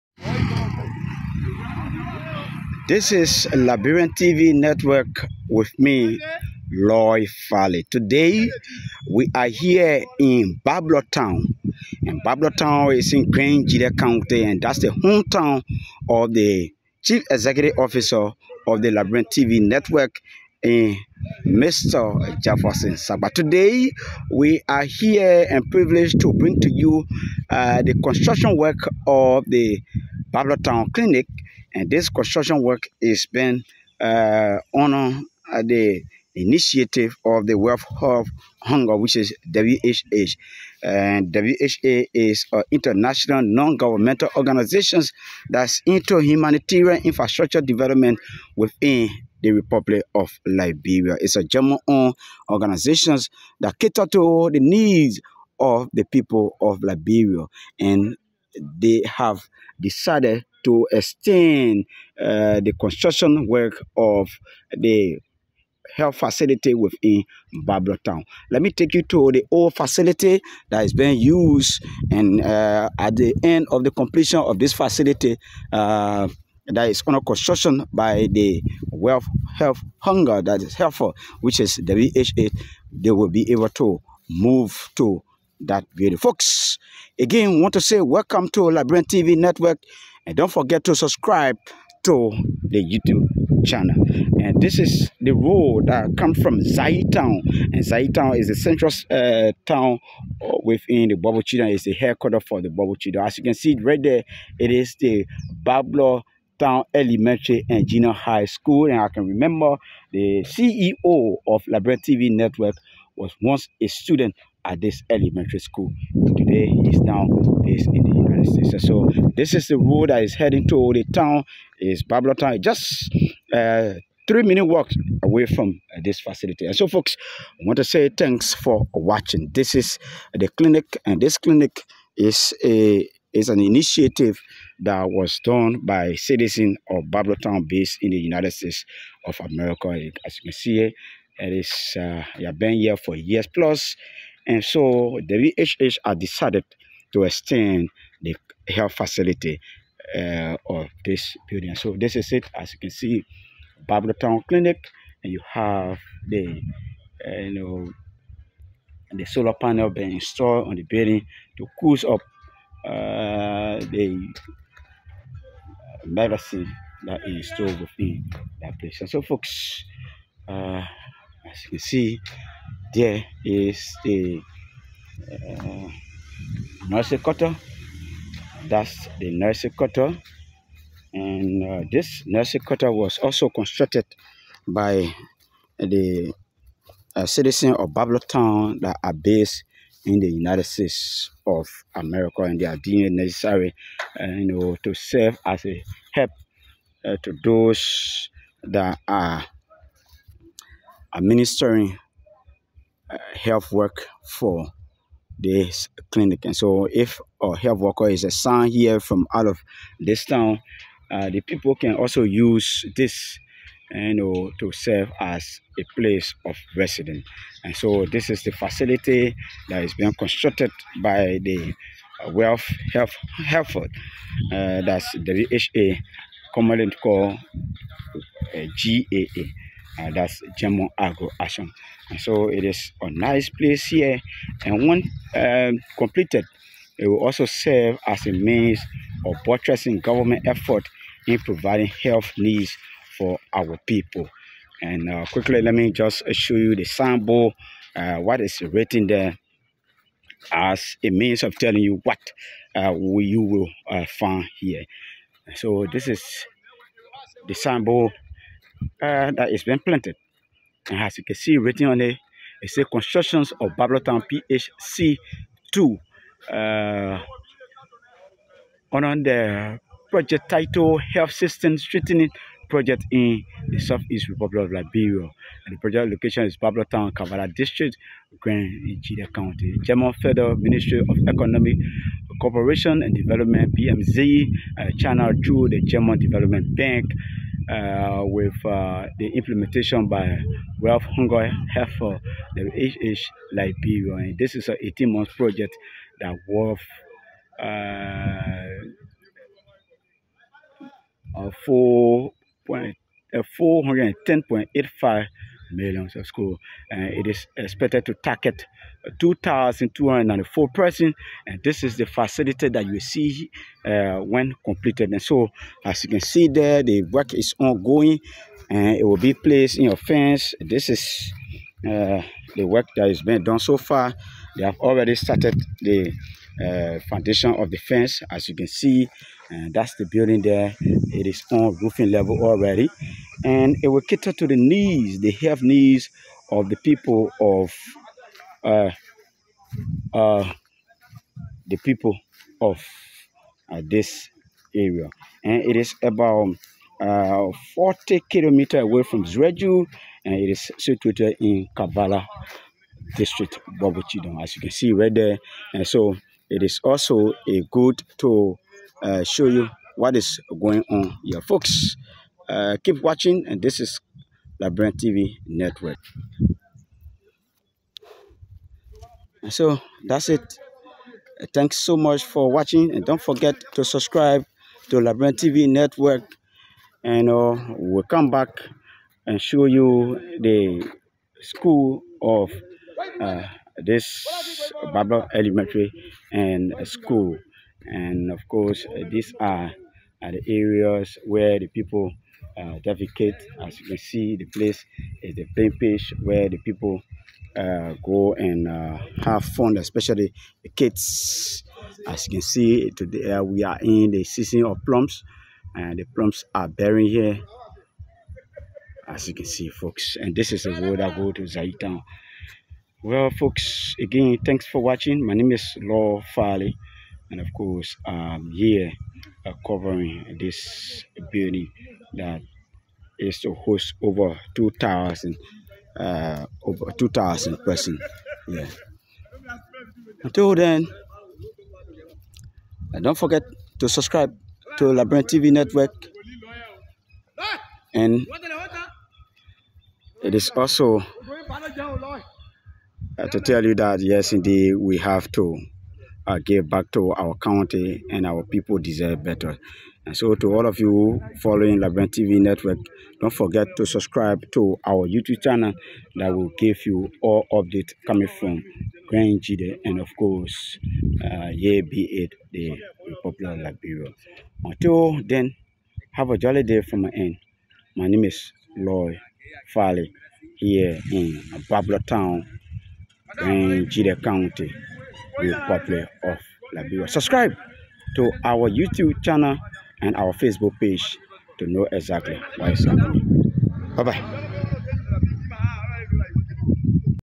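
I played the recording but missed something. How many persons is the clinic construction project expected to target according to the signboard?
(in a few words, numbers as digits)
2,204.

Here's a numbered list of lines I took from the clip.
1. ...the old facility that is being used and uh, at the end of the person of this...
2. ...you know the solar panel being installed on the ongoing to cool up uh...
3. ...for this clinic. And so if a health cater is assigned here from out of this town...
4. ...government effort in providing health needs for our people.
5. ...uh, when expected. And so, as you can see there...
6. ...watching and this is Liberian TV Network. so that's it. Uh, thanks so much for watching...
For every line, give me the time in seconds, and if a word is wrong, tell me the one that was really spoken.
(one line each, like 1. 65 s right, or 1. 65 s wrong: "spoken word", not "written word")
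1. 69 s wrong: "completion", not "person"
2. 157 s wrong: "building", not "ongoing"
3. 204 s wrong: "worker", not "cater"
4. 239 s right
5. 313 s wrong: "completed", not "expected"
6. 363 s right.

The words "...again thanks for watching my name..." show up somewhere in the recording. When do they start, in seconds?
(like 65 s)
413 s.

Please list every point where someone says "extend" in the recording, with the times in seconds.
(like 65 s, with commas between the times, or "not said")
60 s, 147 s.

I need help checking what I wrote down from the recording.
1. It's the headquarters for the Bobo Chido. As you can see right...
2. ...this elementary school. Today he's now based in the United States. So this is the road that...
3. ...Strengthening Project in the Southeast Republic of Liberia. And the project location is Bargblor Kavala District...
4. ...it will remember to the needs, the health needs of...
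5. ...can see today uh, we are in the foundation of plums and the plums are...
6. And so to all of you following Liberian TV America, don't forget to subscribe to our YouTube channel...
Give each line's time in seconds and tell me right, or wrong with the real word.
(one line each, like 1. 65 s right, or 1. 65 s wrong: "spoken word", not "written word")
1. 101 s right
2. 114 s right
3. 271 s right
4. 333 s wrong: "cater", not "remember"
5. 402 s wrong: "season", not "foundation"
6. 450 s wrong: "Network", not "America".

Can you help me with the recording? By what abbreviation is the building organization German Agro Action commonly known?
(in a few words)
GAA.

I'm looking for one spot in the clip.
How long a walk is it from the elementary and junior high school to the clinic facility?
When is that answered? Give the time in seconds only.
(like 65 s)
124 s.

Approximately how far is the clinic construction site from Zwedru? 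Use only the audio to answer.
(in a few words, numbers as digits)
40 kilometers.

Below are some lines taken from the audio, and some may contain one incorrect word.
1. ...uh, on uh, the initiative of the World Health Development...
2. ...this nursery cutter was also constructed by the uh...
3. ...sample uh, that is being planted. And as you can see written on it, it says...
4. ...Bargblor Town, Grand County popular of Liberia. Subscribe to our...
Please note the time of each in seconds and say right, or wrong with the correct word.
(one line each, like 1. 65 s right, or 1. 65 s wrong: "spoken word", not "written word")
1. 33 s wrong: "Hunger", not "Development"
2. 181 s right
3. 257 s right
4. 471 s right.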